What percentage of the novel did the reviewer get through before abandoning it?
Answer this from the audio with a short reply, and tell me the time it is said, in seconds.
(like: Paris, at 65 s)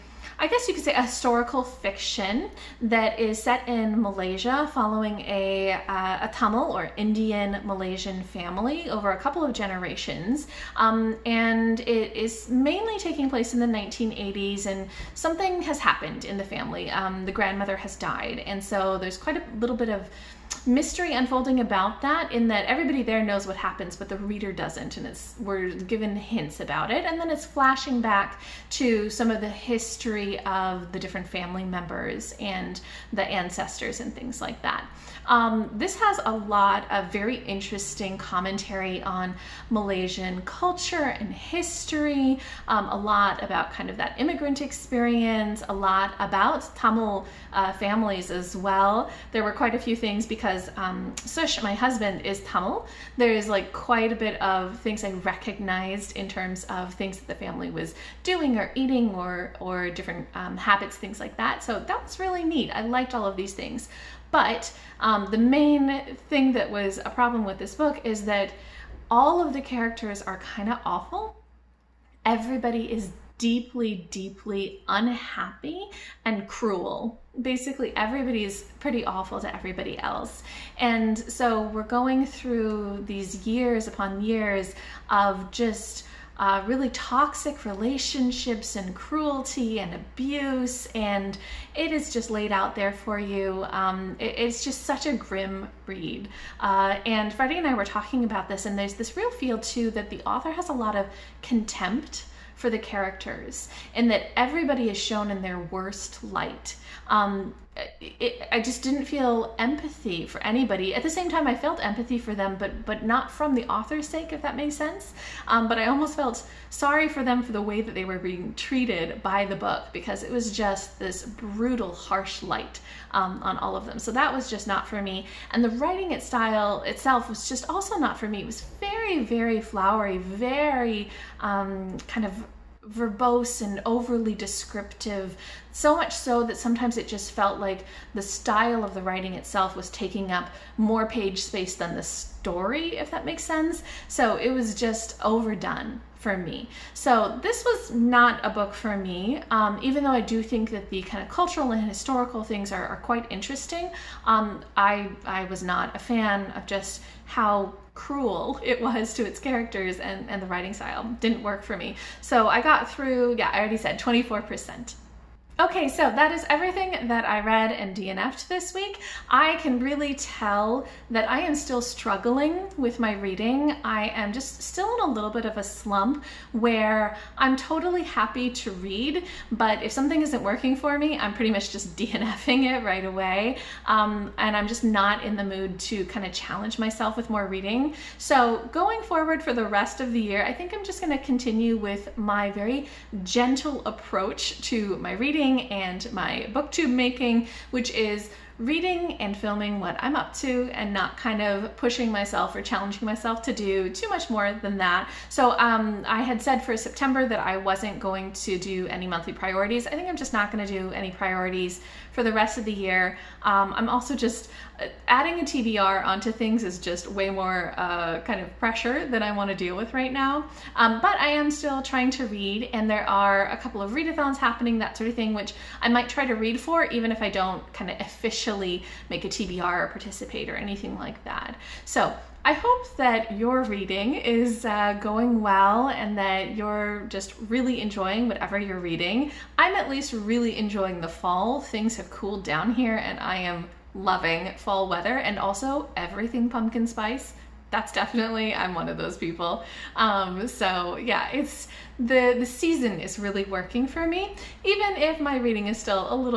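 24%, at 163 s.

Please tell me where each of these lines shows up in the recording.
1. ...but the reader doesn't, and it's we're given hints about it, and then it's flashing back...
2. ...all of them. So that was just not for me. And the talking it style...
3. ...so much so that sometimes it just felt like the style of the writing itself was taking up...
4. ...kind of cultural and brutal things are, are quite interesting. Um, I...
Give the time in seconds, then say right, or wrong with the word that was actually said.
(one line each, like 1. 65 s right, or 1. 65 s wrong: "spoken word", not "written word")
1. 23 s right
2. 123 s wrong: "writing", not "talking"
3. 135 s right
4. 151 s wrong: "historical", not "brutal".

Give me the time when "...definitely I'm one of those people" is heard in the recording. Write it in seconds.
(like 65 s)
247 s.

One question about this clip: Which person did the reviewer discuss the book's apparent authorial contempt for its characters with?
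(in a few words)
Freddie.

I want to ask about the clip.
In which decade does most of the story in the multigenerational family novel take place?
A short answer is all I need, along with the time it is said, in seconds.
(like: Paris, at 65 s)
1980s, at 13 s.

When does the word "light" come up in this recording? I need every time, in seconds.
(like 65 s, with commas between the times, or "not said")
106 s, 122 s.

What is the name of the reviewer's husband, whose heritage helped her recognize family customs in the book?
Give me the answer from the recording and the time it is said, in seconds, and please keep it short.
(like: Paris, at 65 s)
Sush, at 51 s.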